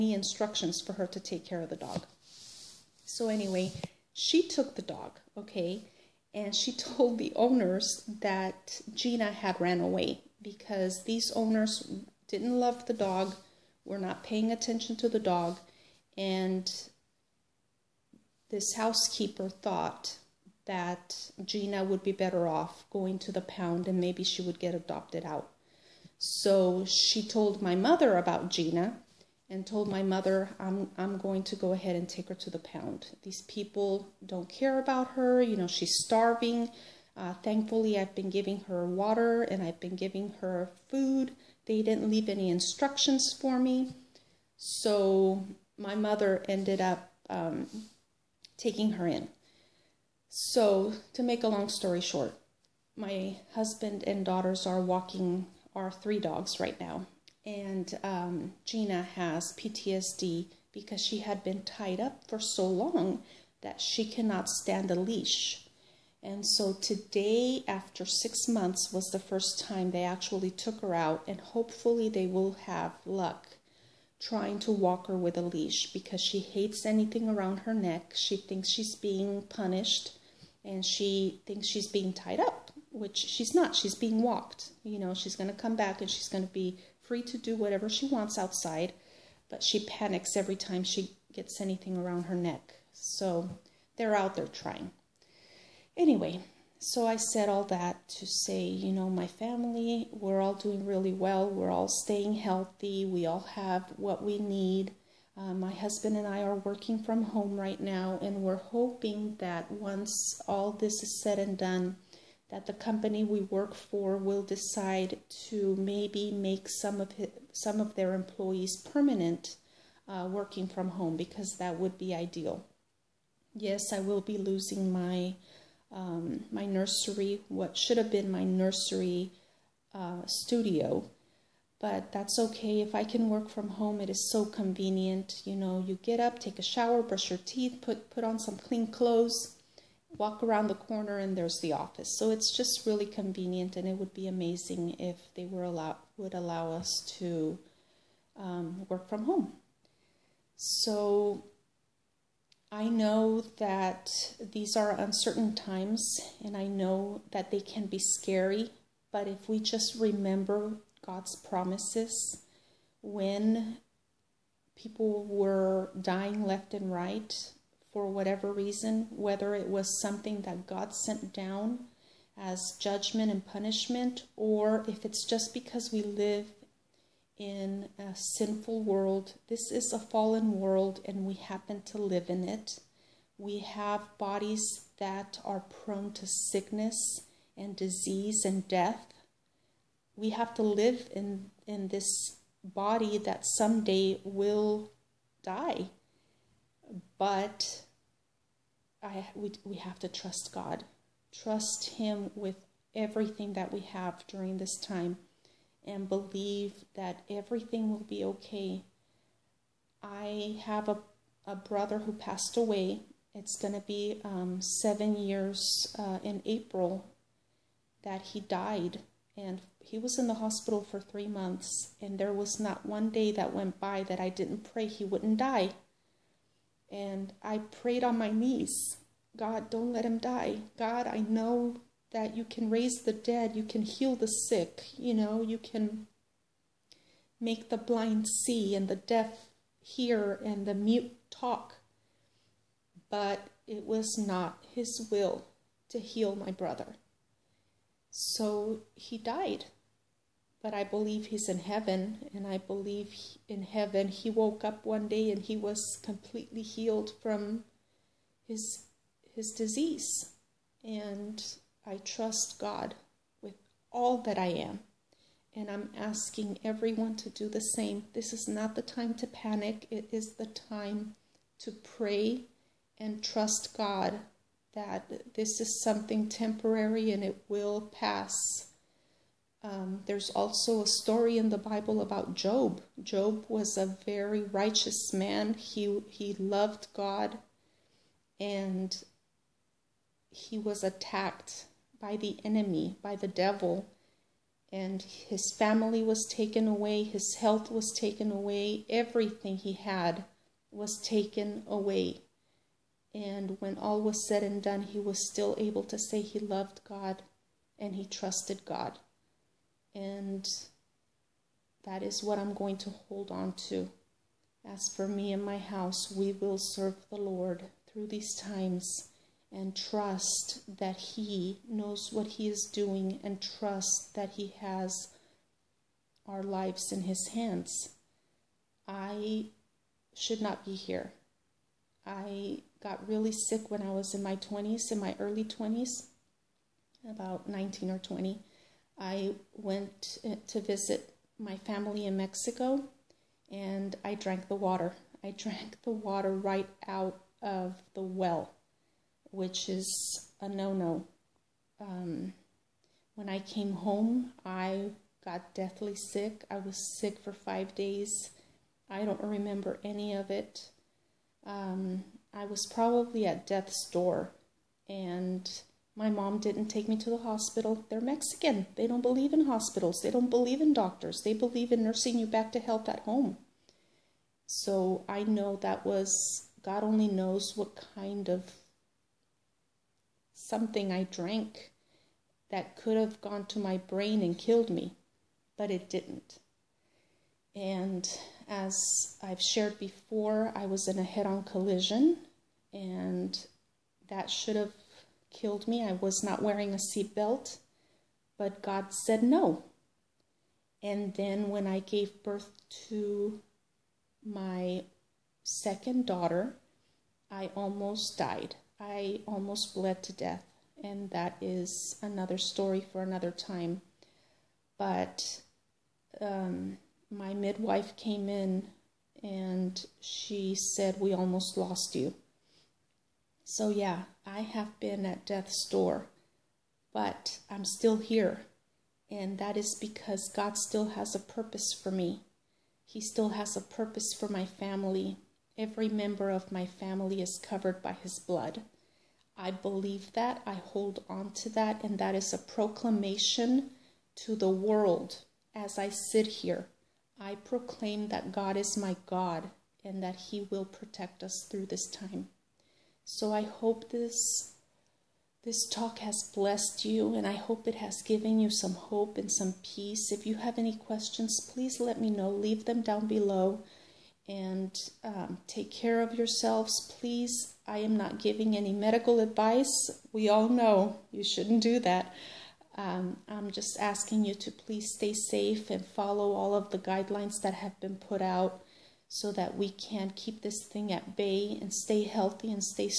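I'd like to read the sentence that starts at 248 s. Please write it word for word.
So he died but I believe he's in heaven.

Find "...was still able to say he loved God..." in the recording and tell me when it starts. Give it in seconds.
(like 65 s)
304 s.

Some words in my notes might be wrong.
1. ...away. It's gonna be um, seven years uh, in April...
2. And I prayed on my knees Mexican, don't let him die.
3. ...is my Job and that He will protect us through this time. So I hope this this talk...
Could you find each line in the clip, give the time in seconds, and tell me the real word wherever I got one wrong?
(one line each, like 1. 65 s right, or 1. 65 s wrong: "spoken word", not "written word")
1. 212 s right
2. 226 s wrong: "God", not "Mexican"
3. 448 s wrong: "God", not "Job".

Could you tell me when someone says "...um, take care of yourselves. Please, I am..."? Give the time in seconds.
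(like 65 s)
465 s.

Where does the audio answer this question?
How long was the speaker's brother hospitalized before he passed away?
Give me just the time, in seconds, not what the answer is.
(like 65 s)
220 s.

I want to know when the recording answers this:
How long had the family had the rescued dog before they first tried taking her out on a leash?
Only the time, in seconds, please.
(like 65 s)
68 s.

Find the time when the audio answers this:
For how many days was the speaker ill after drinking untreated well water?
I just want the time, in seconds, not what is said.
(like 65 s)
357 s.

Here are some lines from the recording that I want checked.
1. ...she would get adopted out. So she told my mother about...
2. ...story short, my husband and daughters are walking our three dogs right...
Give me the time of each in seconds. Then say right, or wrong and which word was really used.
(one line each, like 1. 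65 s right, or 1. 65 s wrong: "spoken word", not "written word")
1. 24 s right
2. 51 s right.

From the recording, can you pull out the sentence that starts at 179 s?
This is a fallen world and we happen to live in it.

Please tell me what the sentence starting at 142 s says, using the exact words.
So it's just really convenient and it would be amazing if they were allow, would allow us to um, work from home.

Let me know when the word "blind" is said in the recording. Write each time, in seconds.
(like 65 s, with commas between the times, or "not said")
237 s.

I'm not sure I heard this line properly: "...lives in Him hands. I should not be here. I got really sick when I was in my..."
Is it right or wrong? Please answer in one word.
wrong.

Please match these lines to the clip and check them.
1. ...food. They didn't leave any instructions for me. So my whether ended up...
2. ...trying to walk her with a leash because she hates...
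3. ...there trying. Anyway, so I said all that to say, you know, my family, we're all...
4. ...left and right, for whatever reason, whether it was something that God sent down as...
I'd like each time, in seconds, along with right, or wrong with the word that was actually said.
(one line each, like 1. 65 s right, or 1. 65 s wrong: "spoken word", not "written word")
1. 40 s wrong: "mother", not "whether"
2. 74 s right
3. 94 s right
4. 166 s right.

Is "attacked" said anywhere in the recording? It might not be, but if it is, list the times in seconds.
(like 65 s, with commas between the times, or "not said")
290 s.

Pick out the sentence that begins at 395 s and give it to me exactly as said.
I was not wearing a seatbelt, but God said no.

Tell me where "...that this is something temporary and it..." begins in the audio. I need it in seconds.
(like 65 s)
274 s.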